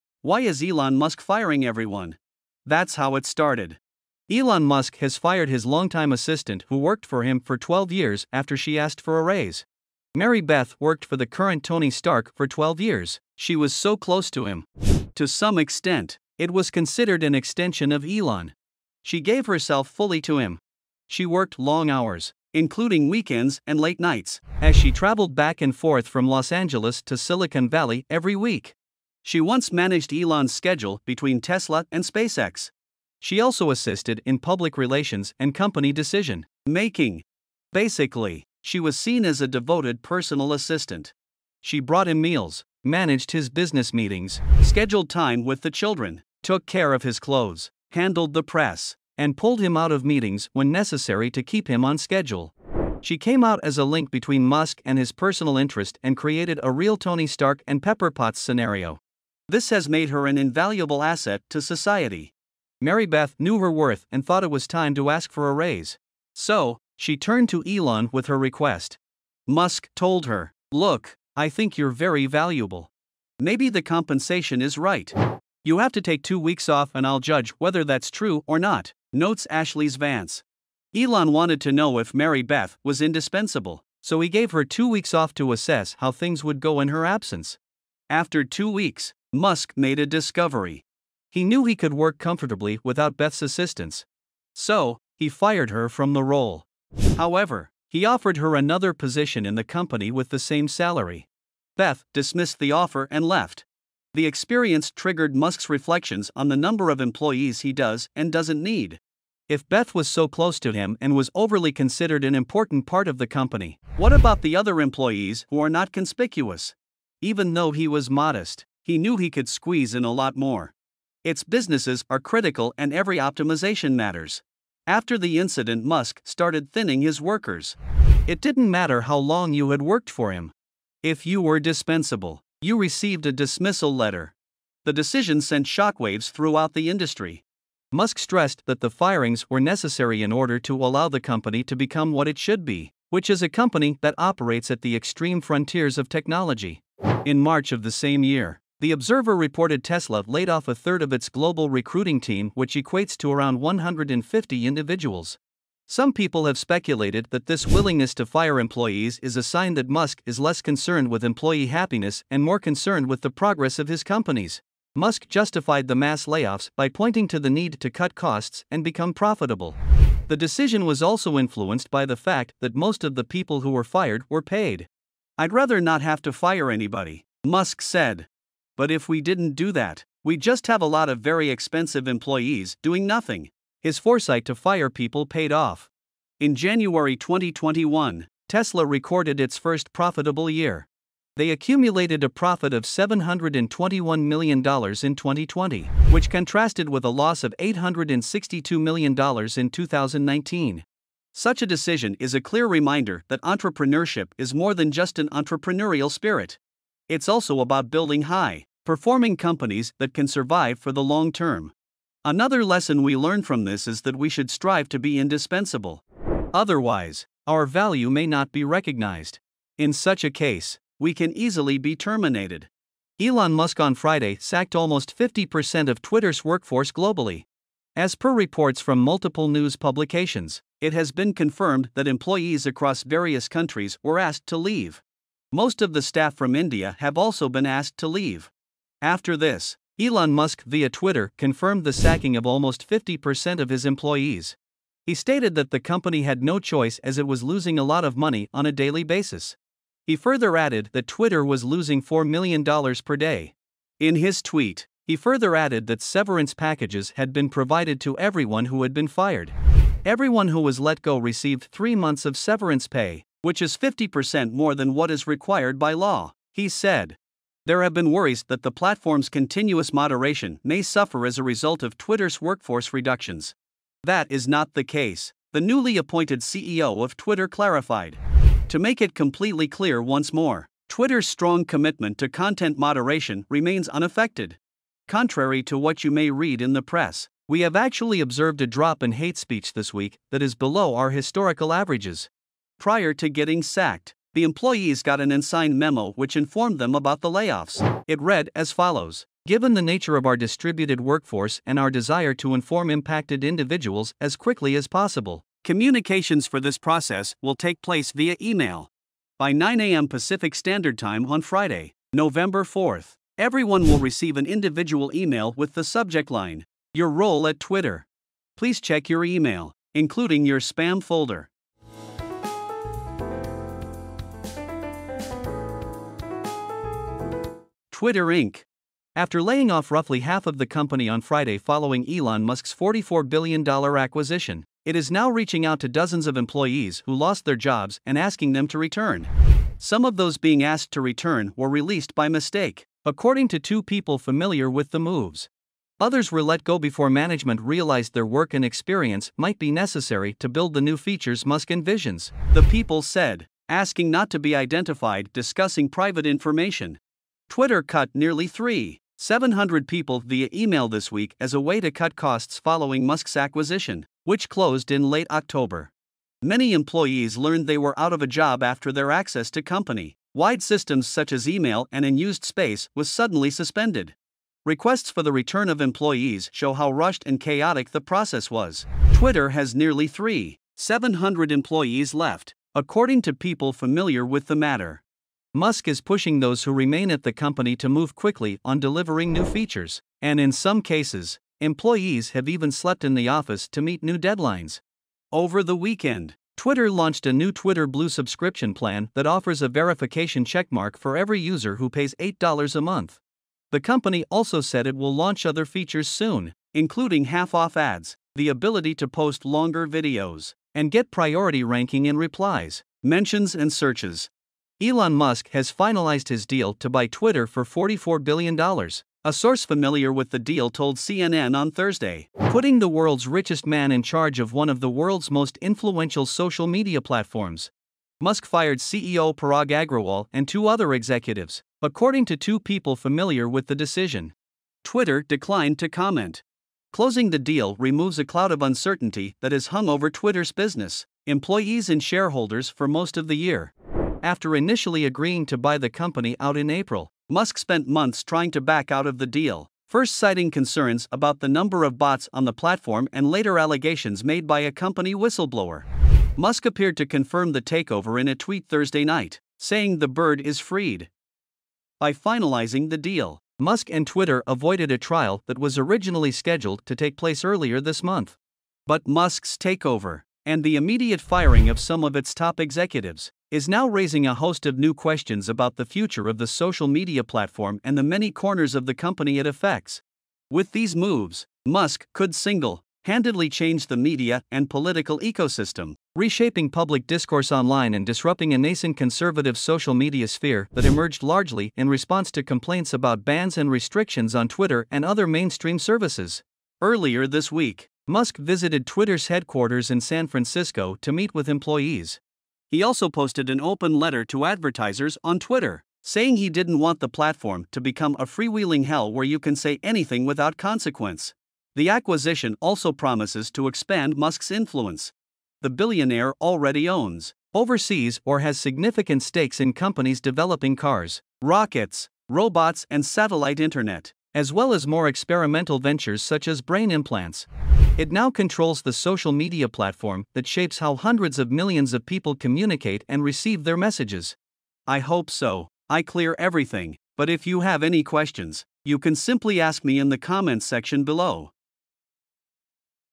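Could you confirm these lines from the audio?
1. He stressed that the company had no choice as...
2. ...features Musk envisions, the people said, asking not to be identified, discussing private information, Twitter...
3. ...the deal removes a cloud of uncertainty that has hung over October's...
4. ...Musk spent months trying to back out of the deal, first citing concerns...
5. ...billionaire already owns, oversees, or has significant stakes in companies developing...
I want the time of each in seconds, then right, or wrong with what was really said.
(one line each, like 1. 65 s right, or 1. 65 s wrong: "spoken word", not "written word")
1. 245 s wrong: "stated", not "stressed"
2. 350 s right
3. 437 s wrong: "Twitter", not "October"
4. 447 s right
5. 515 s right.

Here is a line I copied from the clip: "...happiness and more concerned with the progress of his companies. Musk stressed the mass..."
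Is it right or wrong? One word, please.
wrong.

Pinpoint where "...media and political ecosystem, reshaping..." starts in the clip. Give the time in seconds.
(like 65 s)
483 s.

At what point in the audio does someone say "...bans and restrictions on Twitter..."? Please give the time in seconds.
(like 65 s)
493 s.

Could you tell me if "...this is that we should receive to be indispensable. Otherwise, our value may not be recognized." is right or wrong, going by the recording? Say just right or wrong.
wrong.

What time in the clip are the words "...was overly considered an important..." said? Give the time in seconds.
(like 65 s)
111 s.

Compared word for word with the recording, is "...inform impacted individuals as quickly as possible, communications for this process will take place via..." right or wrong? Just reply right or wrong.
right.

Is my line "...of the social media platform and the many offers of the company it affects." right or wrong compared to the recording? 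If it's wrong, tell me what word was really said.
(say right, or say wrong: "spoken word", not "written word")
wrong: "corners", not "offers".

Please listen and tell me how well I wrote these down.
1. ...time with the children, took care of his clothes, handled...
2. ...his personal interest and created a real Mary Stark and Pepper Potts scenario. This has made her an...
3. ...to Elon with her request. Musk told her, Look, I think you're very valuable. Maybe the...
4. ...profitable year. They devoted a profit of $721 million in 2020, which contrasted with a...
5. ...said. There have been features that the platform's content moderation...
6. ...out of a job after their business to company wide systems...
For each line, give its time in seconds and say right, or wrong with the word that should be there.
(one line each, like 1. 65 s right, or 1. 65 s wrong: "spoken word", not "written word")
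1. 45 s right
2. 54 s wrong: "Tony", not "Mary"
3. 67 s right
4. 189 s wrong: "accumulated", not "devoted"
5. 266 s wrong: "worries", not "features"
6. 367 s wrong: "access", not "business".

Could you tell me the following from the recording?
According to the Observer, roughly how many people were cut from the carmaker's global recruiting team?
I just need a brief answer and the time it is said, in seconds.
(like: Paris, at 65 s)
150, at 153 s.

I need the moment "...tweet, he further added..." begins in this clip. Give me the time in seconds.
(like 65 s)
254 s.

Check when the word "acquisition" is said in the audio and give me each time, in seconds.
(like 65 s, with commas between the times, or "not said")
333 s, 363 s, 511 s.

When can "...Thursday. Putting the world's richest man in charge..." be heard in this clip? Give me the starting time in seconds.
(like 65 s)
421 s.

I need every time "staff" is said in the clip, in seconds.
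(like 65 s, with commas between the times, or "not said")
236 s.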